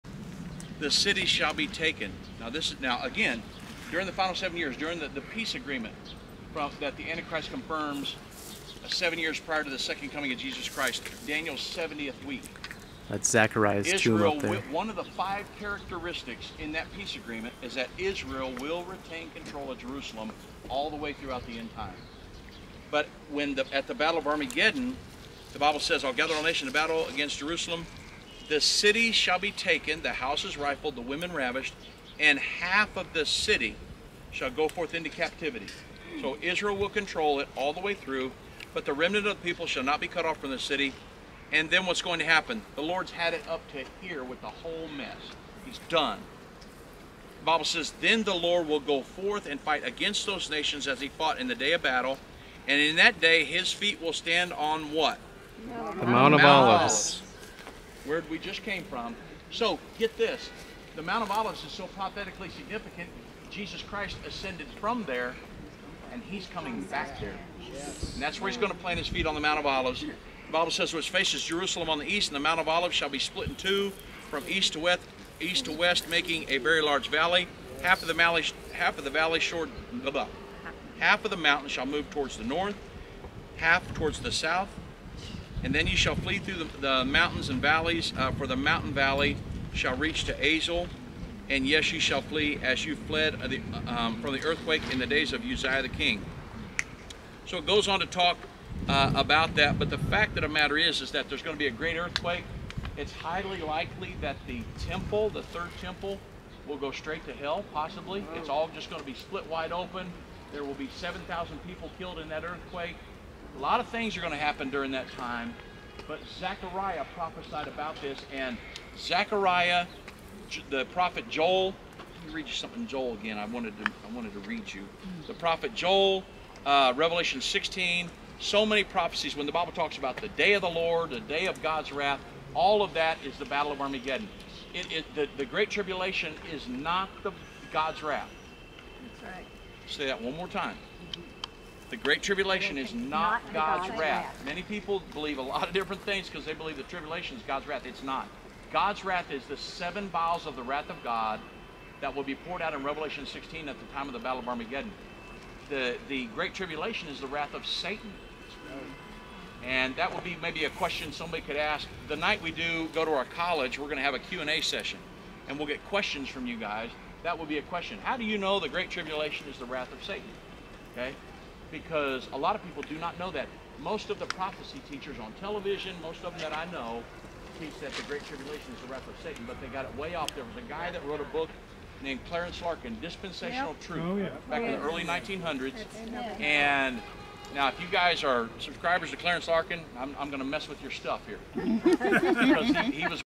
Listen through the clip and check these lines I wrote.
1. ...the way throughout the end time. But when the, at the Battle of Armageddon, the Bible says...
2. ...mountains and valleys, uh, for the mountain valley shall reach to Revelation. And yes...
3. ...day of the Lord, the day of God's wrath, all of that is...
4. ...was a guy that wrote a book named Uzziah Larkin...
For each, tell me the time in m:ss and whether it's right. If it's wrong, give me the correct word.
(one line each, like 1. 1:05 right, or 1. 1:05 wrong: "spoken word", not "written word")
1. 0:20 right
2. 1:27 wrong: "Azel", not "Revelation"
3. 2:10 right
4. 3:00 wrong: "Clarence", not "Uzziah".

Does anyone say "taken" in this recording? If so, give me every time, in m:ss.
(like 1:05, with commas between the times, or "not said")
0:01, 0:29.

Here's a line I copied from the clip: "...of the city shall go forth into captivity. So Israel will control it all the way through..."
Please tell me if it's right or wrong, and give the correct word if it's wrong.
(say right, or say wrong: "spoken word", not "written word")
right.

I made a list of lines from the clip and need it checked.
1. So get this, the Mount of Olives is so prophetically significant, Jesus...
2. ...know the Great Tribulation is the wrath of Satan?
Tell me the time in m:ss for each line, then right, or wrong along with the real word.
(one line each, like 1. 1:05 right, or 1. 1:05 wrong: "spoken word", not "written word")
1. 0:59 right
2. 2:48 right.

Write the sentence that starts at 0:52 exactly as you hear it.
And in that day his feet will stand on what?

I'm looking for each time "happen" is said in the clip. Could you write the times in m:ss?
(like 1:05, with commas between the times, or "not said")
0:42, 1:54.